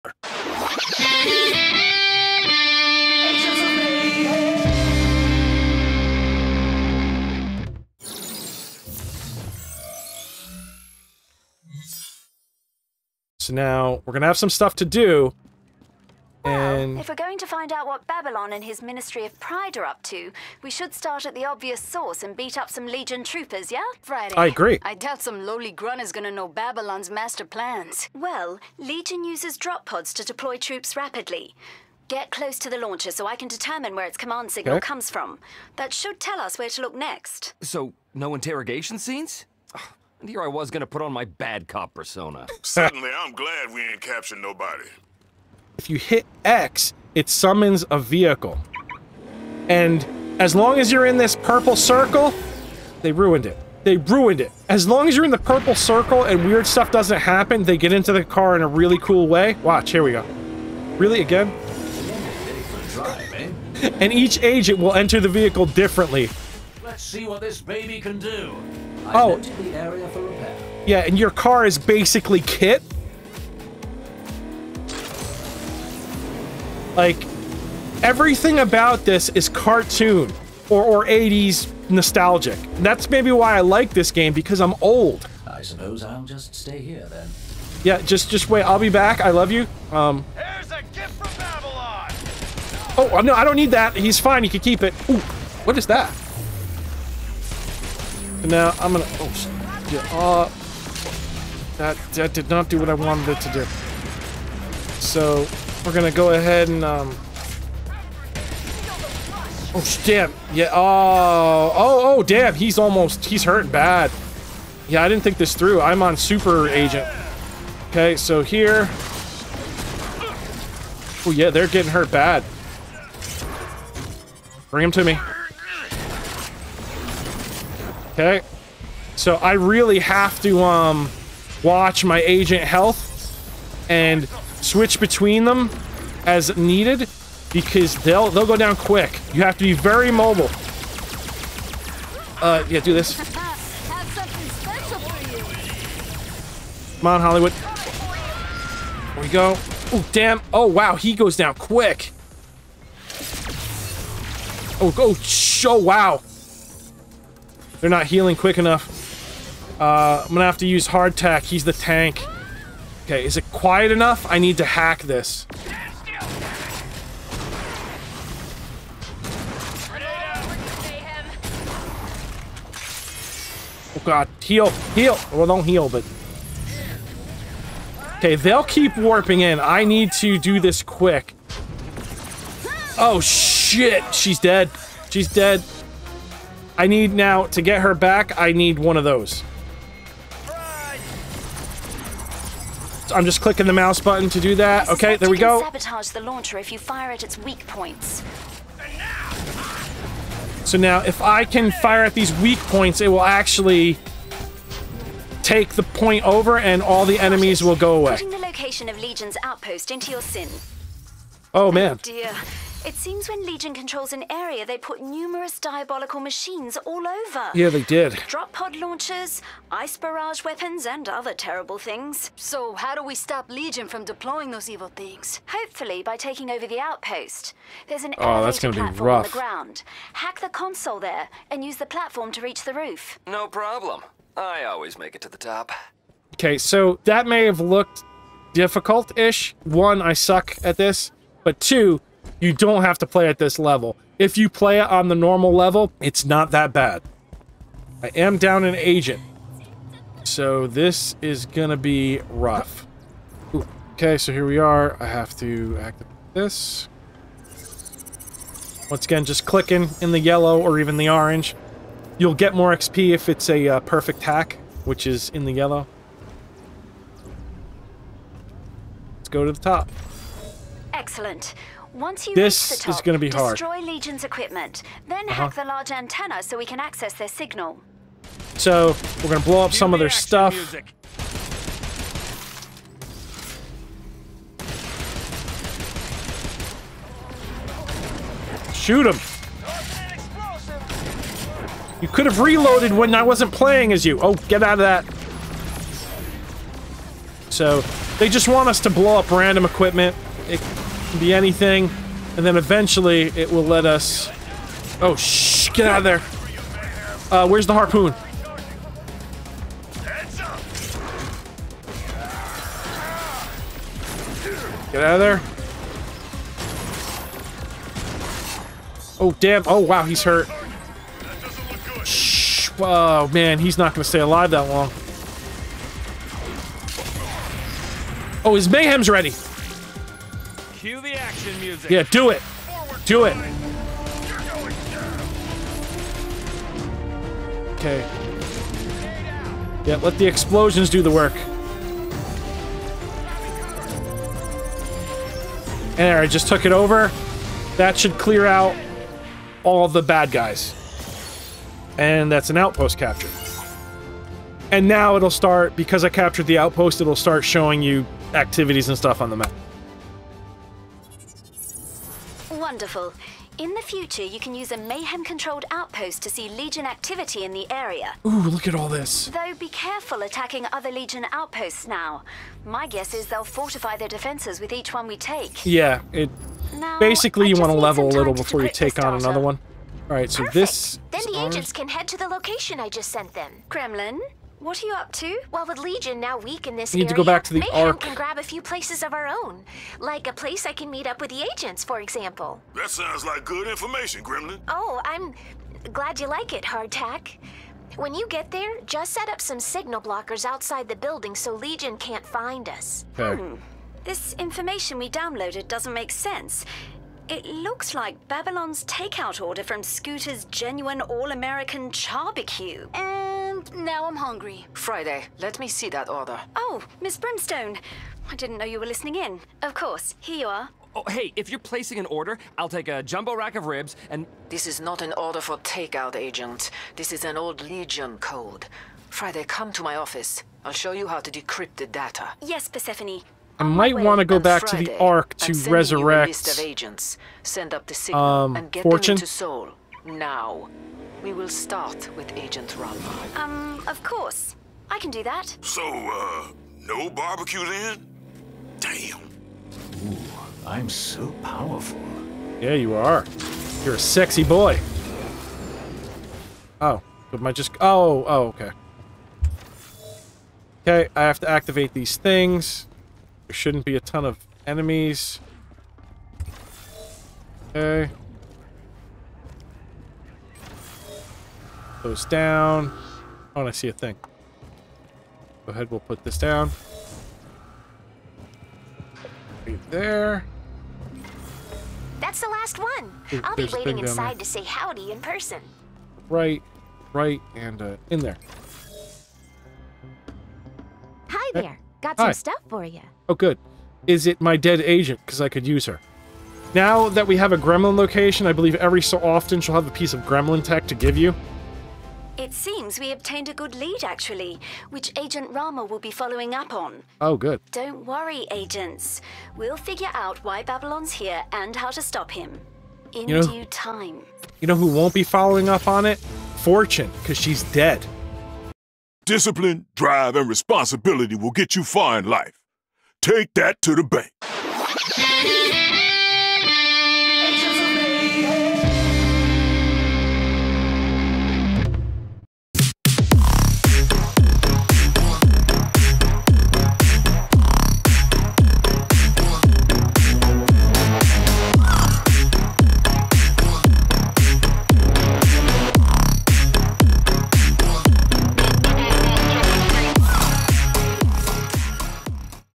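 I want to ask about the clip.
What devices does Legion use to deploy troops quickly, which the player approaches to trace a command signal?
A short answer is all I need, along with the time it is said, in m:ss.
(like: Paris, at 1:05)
Drop pods, at 0:29.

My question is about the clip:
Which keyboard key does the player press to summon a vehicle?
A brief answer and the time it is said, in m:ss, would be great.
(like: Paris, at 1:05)
X, at 0:46.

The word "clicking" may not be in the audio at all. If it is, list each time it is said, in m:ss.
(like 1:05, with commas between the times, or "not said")
3:13, 4:19.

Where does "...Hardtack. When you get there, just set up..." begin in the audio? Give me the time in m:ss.
6:36.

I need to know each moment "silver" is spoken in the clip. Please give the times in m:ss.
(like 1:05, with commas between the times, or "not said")
not said.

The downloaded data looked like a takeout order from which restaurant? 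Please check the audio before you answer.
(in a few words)
Scooter's genuine all-American charbecue.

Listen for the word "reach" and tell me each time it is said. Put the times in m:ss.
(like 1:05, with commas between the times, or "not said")
3:52, 4:32.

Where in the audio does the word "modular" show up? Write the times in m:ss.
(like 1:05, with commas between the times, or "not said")
not said.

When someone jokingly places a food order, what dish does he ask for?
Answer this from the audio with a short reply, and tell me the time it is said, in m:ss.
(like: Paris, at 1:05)
Jumbo rack of ribs, at 7:03.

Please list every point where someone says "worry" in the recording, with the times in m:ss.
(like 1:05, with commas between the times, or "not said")
8:28.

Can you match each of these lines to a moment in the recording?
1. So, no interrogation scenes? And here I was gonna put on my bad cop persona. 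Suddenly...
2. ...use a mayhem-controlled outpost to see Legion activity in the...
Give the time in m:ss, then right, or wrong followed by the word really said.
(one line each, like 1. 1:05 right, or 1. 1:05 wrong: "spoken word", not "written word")
1. 0:37 right
2. 6:04 right.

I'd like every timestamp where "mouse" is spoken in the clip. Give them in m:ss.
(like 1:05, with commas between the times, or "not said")
3:13.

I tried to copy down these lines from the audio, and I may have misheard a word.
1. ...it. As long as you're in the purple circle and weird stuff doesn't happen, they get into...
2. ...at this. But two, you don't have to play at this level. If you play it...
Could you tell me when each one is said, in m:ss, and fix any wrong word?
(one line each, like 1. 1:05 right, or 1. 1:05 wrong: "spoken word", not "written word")
1. 0:54 right
2. 4:00 right.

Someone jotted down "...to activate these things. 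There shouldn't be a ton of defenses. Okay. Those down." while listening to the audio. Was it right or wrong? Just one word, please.
wrong.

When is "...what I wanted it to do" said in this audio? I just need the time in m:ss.
1:42.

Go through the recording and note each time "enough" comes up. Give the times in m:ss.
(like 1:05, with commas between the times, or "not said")
2:38, 2:43.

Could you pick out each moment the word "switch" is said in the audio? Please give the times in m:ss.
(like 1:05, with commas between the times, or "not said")
2:14.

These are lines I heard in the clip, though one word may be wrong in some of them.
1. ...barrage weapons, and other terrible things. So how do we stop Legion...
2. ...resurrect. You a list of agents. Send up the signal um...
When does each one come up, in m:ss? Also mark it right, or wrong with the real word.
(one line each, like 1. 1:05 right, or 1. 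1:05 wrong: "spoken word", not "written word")
1. 3:39 right
2. 7:15 right.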